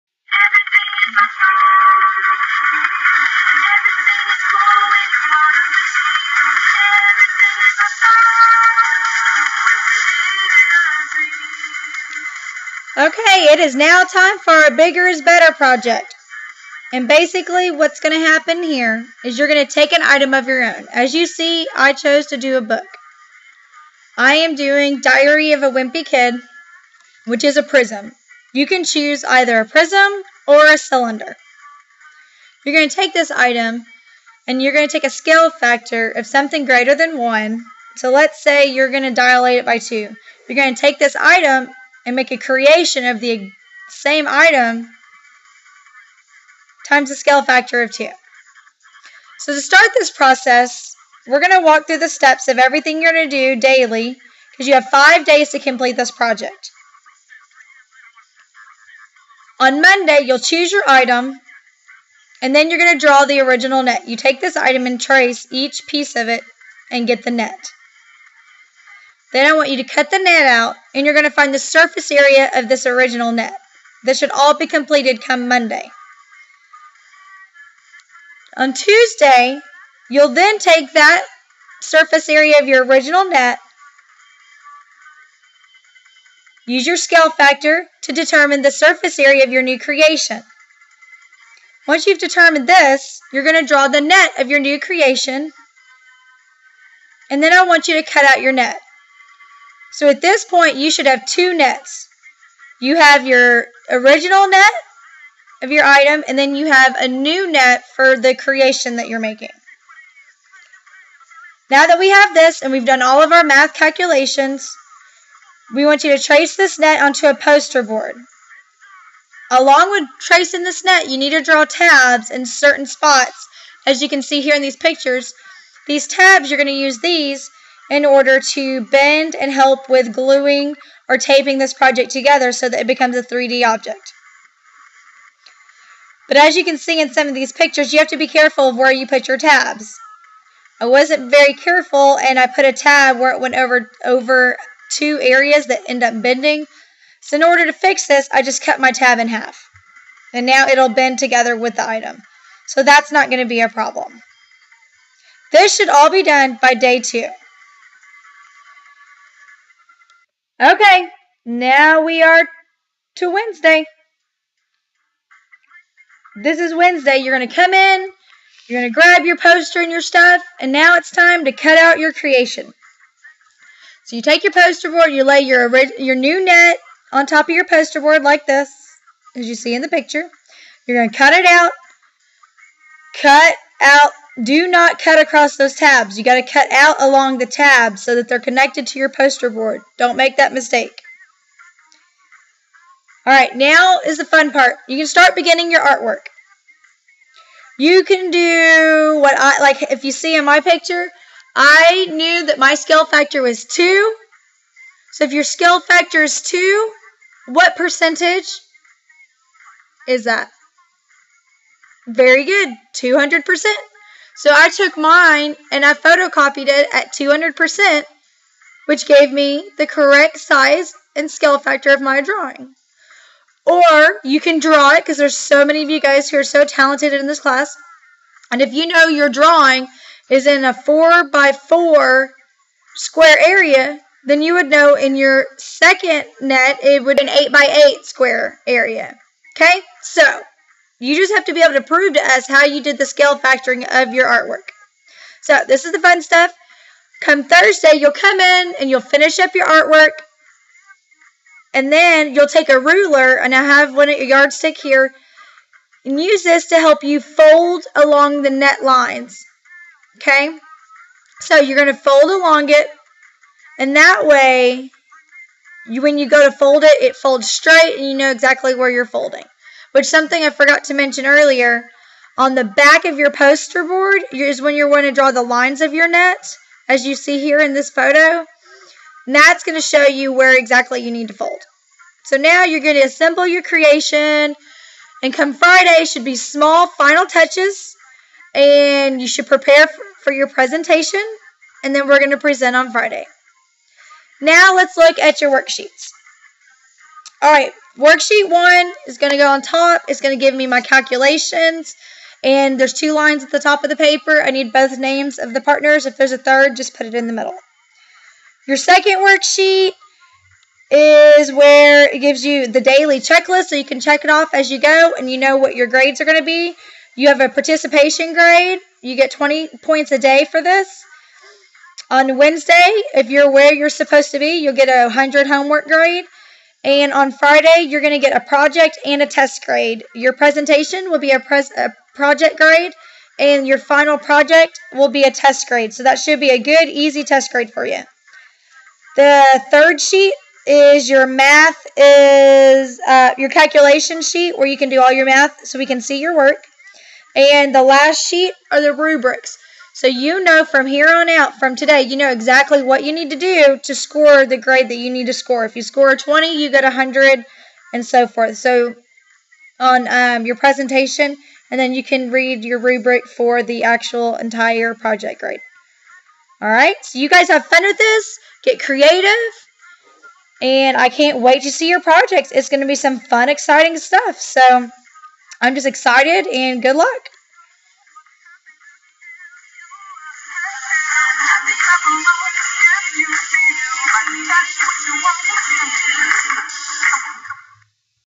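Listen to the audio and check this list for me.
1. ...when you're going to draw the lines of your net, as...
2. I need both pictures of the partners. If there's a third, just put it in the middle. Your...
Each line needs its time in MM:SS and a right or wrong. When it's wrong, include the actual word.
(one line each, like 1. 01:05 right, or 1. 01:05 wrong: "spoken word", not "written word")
1. 04:34 right
2. 05:04 wrong: "names", not "pictures".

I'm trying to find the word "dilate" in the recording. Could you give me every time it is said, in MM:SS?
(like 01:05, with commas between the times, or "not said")
00:39.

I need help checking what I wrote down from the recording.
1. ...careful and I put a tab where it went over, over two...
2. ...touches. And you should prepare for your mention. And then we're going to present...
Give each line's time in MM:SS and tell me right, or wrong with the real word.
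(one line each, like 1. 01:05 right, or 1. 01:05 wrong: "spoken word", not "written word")
1. 02:21 right
2. 04:47 wrong: "presentation", not "mention".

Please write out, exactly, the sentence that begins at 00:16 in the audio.
And basically what's going to happen here is you're going to take an item of your own.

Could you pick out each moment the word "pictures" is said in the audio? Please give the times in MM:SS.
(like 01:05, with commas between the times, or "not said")
02:04, 02:17, 02:59, 03:20.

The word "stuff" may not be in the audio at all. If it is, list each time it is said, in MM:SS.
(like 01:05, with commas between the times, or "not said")
02:50, 04:06, 06:13.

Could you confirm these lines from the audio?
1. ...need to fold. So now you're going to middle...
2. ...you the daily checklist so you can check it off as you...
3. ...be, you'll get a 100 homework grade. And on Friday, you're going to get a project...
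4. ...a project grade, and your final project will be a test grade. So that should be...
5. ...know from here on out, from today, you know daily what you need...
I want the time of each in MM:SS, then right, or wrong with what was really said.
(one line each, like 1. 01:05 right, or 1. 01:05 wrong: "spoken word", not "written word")
1. 04:41 wrong: "assemble", not "middle"
2. 05:12 right
3. 05:24 right
4. 05:31 right
5. 05:50 wrong: "exactly", not "daily".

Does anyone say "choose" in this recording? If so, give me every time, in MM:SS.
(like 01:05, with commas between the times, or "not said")
00:28, 01:00.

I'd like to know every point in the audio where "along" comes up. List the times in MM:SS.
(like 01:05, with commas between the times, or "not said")
01:59, 03:07, 04:17, 04:22.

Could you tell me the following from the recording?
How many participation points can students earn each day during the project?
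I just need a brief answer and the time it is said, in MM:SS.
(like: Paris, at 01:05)
20, at 05:19.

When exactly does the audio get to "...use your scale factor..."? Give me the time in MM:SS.
01:26.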